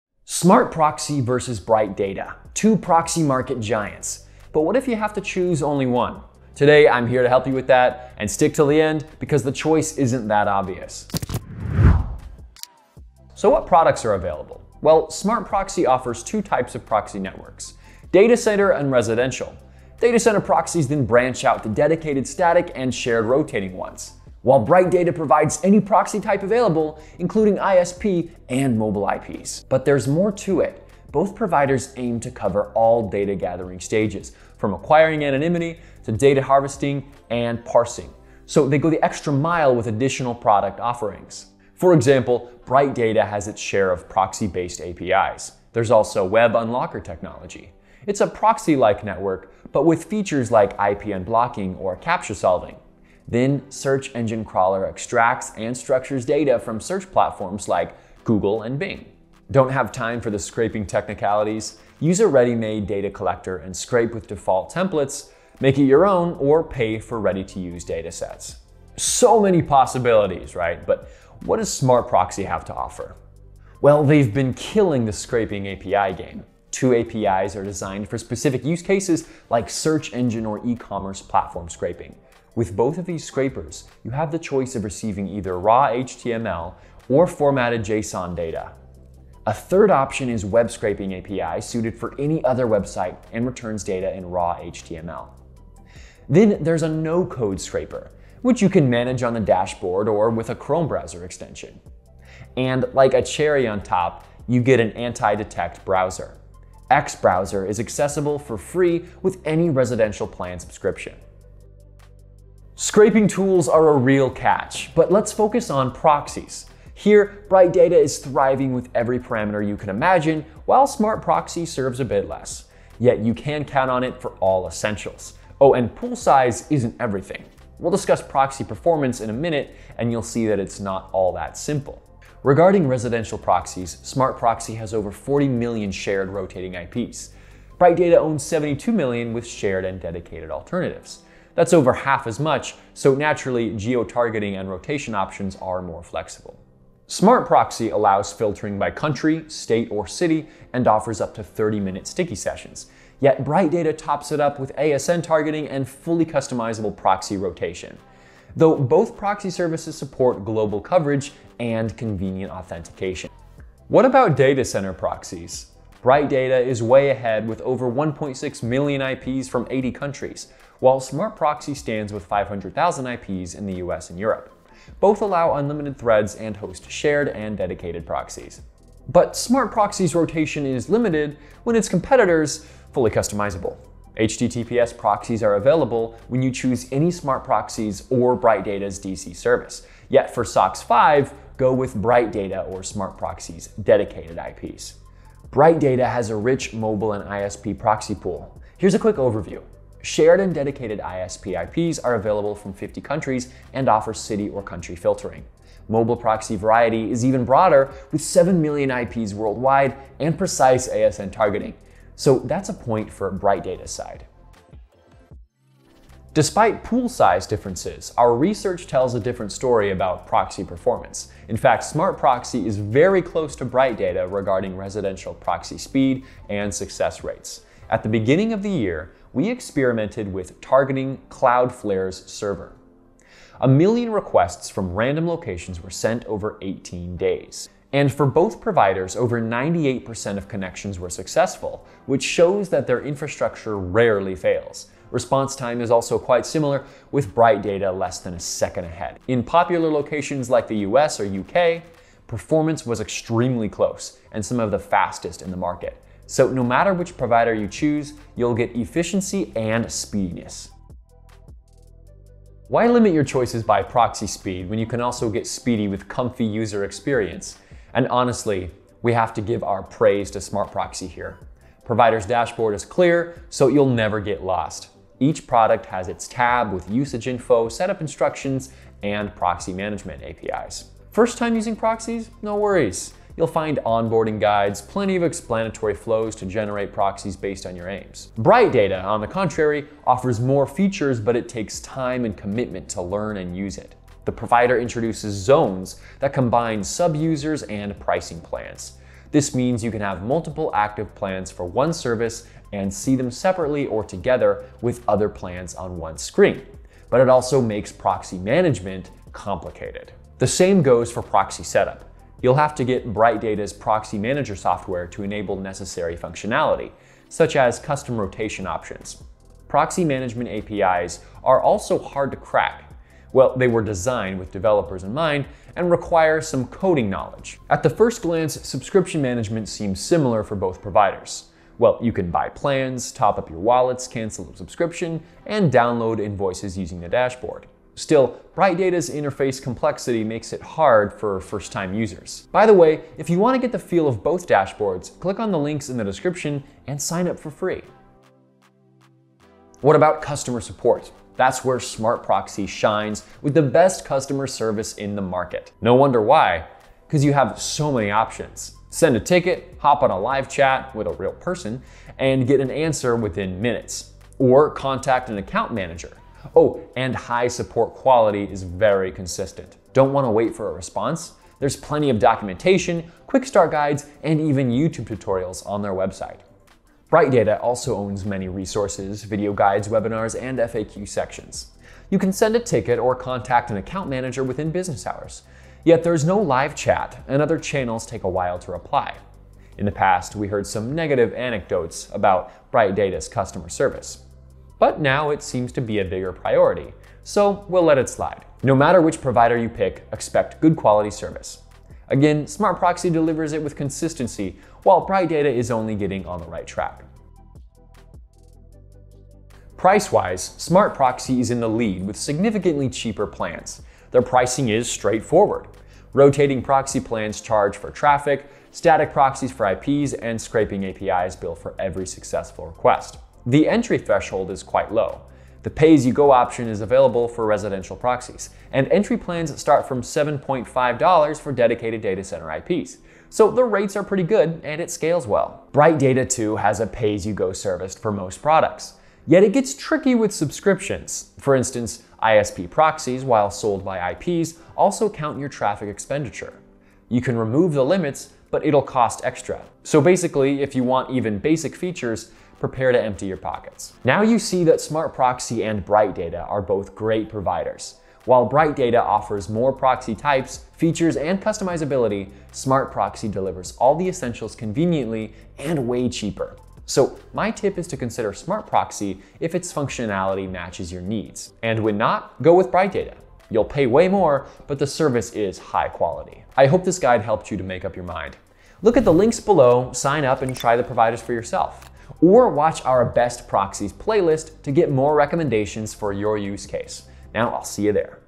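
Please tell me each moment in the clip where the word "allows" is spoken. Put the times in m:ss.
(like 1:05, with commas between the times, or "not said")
2:27, 2:55.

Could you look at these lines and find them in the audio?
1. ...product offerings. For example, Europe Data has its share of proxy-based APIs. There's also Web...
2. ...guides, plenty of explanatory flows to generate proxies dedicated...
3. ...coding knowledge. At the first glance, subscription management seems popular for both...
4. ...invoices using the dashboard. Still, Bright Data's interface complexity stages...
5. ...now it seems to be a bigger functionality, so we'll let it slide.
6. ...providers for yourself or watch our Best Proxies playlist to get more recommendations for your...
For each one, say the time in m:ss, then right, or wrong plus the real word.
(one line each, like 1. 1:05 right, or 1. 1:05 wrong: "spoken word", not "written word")
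1. 0:40 wrong: "Bright", not "Europe"
2. 4:44 wrong: "based", not "dedicated"
3. 5:26 wrong: "similar", not "popular"
4. 5:36 wrong: "makes", not "stages"
5. 6:34 wrong: "priority", not "functionality"
6. 8:00 right.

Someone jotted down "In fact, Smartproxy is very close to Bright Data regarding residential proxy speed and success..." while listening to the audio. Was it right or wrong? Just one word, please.
right.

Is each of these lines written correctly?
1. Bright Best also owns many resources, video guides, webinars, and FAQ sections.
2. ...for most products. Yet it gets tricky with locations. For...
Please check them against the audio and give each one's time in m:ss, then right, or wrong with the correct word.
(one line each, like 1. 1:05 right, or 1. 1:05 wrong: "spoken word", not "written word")
1. 6:17 wrong: "Data", not "Best"
2. 7:17 wrong: "subscriptions", not "locations".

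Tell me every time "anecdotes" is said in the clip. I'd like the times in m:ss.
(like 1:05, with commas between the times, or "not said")
6:31.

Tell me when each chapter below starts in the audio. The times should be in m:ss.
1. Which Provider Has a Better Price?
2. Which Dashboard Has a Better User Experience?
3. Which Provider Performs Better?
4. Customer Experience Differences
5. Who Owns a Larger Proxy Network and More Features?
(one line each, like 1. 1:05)
1. 7:00
2. 4:36
3. 3:48
4. 6:02
5. 1:52.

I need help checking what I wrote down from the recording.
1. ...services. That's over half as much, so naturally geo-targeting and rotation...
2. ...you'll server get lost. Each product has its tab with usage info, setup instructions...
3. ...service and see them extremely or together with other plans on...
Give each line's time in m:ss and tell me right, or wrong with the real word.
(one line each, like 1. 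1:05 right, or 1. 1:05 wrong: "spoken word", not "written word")
1. 2:20 wrong: "alternatives", not "services"
2. 4:33 wrong: "never", not "server"
3. 5:01 wrong: "separately", not "extremely".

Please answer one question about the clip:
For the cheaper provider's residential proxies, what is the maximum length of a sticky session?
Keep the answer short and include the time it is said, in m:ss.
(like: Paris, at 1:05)
30 minutes, at 2:31.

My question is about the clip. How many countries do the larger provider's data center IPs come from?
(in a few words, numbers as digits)
80.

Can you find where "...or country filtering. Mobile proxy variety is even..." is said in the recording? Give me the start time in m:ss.
3:24.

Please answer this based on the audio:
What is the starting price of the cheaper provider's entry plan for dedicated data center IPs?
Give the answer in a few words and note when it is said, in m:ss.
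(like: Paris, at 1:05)
$7.5, at 7:10.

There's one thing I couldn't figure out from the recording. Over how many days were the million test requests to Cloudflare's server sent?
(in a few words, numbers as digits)
18 days.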